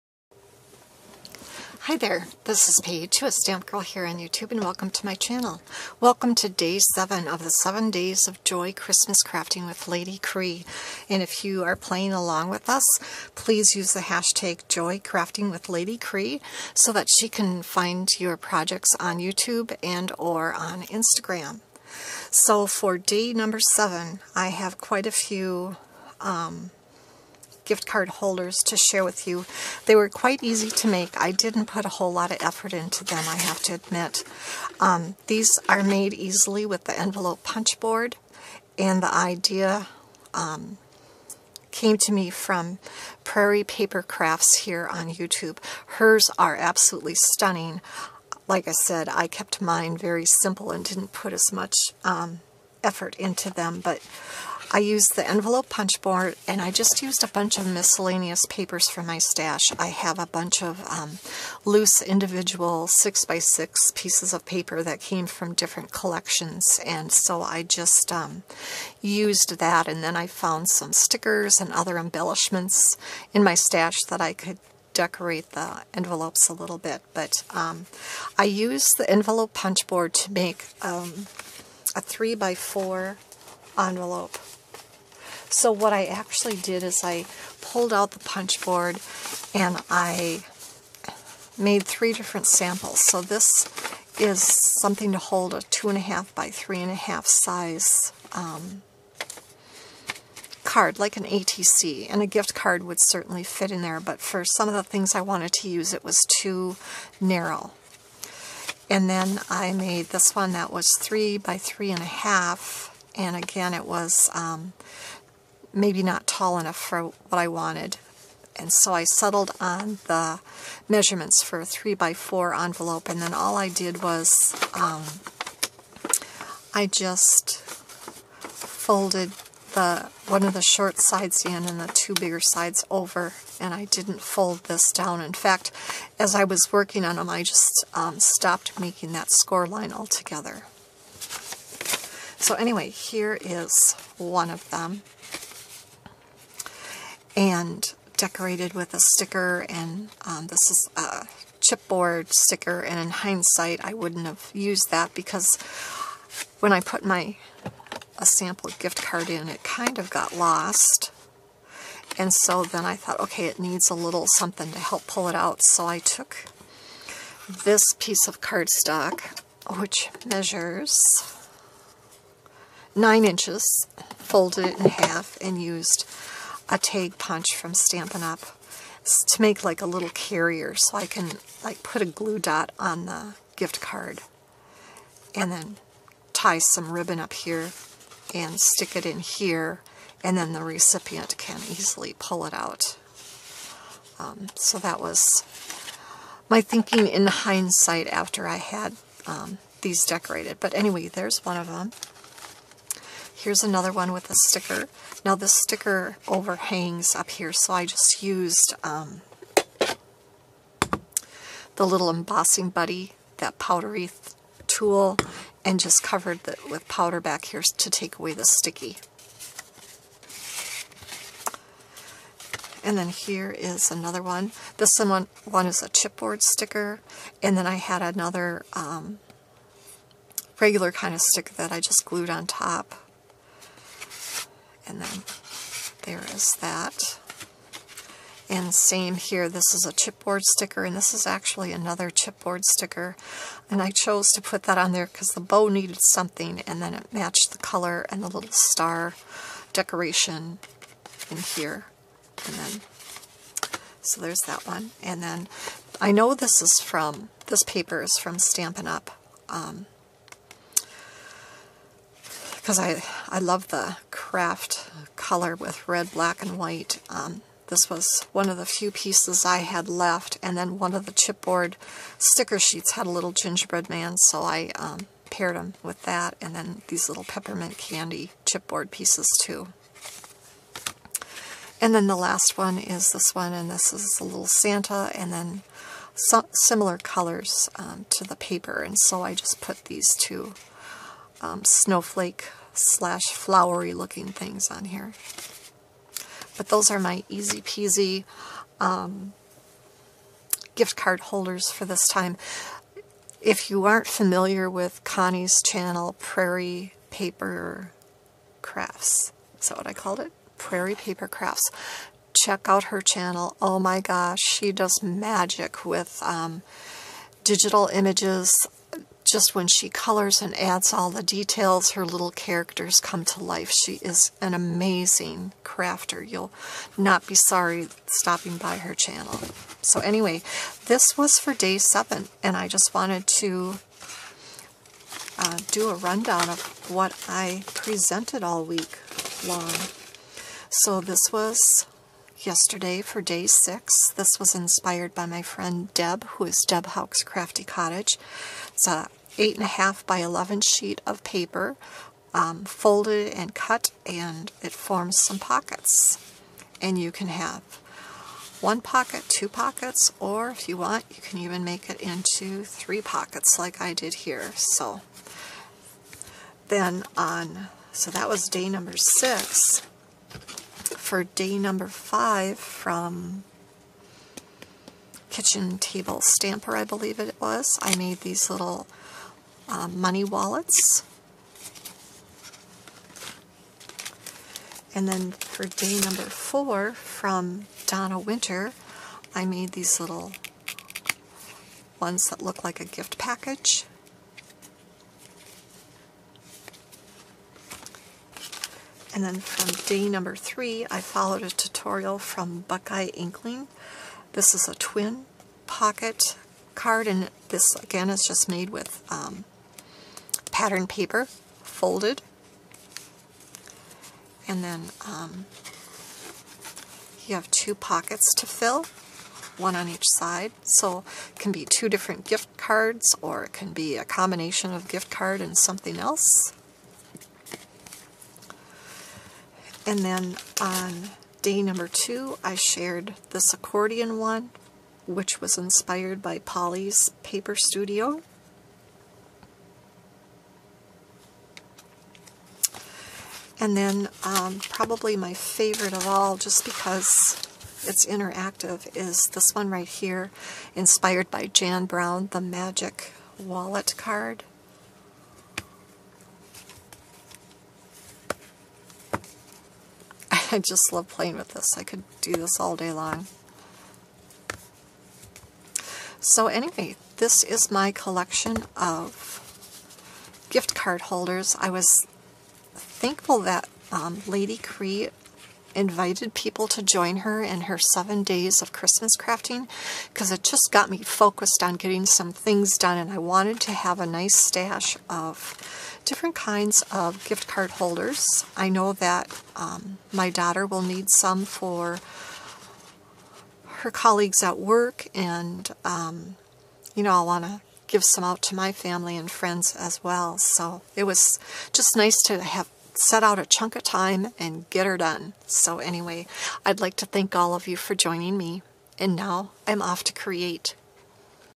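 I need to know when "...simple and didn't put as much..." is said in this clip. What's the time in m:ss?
0:50.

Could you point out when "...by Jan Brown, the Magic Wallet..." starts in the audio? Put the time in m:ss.
7:31.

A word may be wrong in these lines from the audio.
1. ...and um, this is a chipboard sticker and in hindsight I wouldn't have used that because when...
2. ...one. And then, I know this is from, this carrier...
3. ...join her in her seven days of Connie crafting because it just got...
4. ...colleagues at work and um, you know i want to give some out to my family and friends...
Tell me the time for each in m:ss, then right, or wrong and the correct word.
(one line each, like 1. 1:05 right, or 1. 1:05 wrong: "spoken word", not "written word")
1. 2:29 right
2. 4:14 wrong: "paper", not "carrier"
3. 7:56 wrong: "Christmas", not "Connie"
4. 8:13 right.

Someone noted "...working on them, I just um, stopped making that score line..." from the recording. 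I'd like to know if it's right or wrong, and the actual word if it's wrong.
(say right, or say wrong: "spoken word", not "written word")
right.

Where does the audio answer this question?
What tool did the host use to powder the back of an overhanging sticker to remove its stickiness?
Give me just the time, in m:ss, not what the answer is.
3:32.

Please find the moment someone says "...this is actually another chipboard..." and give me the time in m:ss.
4:00.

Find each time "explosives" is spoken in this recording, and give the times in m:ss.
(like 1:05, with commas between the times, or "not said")
not said.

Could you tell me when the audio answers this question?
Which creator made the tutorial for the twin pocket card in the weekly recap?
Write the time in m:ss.
6:42.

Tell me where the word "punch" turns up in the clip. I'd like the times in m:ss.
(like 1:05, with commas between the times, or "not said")
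0:37, 0:55, 1:19, 1:28, 2:57.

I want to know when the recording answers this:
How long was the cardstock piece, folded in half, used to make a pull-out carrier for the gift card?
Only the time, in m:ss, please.
2:52.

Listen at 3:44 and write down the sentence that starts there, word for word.
This one, one is a chipboard sticker.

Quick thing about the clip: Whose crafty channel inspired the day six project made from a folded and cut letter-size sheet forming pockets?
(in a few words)
Deb Houck's Crafty Cottage.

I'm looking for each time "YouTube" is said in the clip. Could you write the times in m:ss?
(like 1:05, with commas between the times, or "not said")
0:04, 0:19, 0:45.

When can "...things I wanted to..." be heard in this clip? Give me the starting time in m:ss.
1:44.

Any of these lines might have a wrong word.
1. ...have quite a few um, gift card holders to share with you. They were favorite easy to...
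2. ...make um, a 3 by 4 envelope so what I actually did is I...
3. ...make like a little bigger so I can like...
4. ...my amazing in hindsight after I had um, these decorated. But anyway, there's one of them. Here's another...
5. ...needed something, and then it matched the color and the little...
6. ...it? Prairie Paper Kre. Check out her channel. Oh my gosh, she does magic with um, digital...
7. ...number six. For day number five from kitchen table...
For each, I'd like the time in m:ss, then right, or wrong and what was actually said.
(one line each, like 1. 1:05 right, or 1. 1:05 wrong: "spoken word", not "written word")
1. 0:24 wrong: "quite", not "favorite"
2. 1:20 right
3. 2:59 wrong: "carrier", not "bigger"
4. 3:16 wrong: "thinking", not "amazing"
5. 4:05 right
6. 5:10 wrong: "Crafts", not "Kre"
7. 6:08 right.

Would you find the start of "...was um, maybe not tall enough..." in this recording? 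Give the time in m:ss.
1:53.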